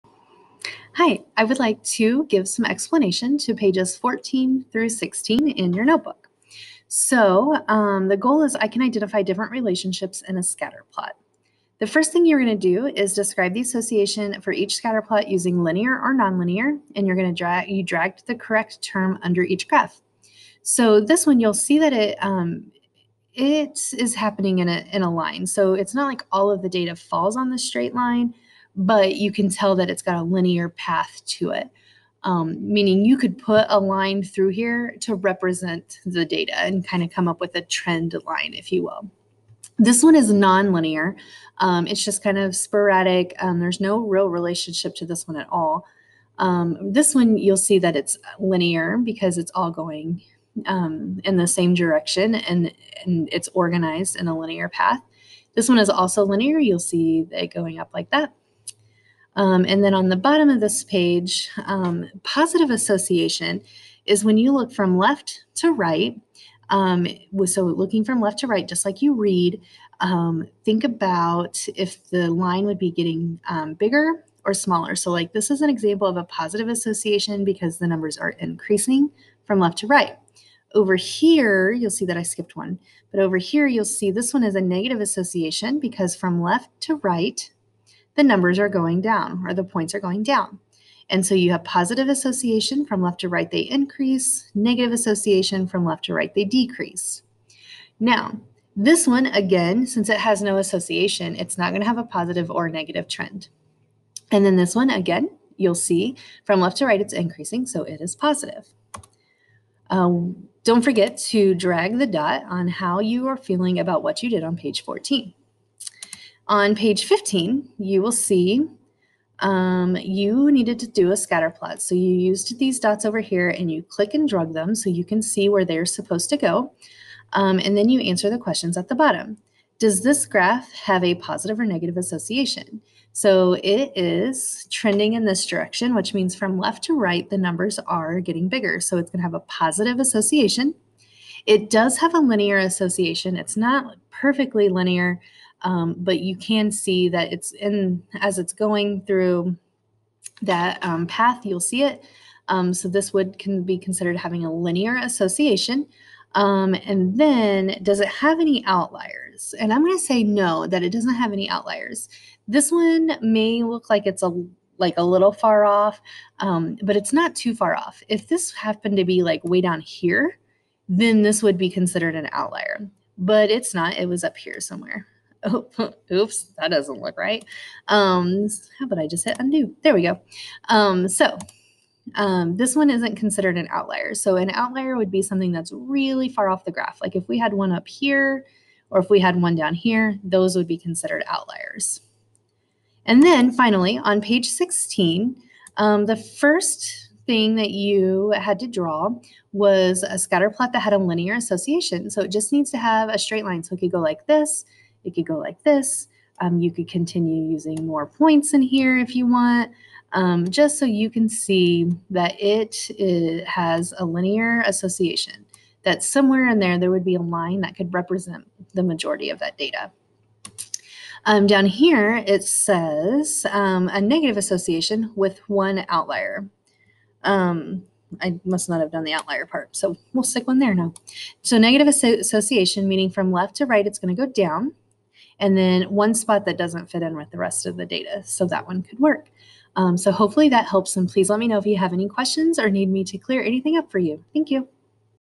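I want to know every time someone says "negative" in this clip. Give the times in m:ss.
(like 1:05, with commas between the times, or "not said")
1:24, 1:34, 1:42, 2:11, 3:44, 3:51.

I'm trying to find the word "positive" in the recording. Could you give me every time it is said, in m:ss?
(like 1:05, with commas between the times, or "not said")
1:02, 1:16, 1:31, 1:42, 1:48, 2:11, 2:19.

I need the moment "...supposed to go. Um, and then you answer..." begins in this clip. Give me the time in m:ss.
2:05.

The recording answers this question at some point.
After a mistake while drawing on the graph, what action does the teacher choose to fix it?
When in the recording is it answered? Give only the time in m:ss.
2:59.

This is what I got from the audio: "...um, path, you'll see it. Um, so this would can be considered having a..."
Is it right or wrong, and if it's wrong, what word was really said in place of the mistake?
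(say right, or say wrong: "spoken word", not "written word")
right.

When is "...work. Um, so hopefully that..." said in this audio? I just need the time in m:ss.
3:58.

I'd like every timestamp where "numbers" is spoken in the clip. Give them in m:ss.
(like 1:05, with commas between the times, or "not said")
1:17, 1:28, 2:17.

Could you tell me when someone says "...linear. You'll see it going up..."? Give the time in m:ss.
0:56.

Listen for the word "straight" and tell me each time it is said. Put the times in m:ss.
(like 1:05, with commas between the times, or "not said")
0:27, 3:23.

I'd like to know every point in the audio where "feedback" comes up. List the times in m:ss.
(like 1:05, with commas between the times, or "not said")
not said.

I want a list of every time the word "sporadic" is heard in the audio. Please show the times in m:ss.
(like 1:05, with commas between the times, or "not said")
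0:42.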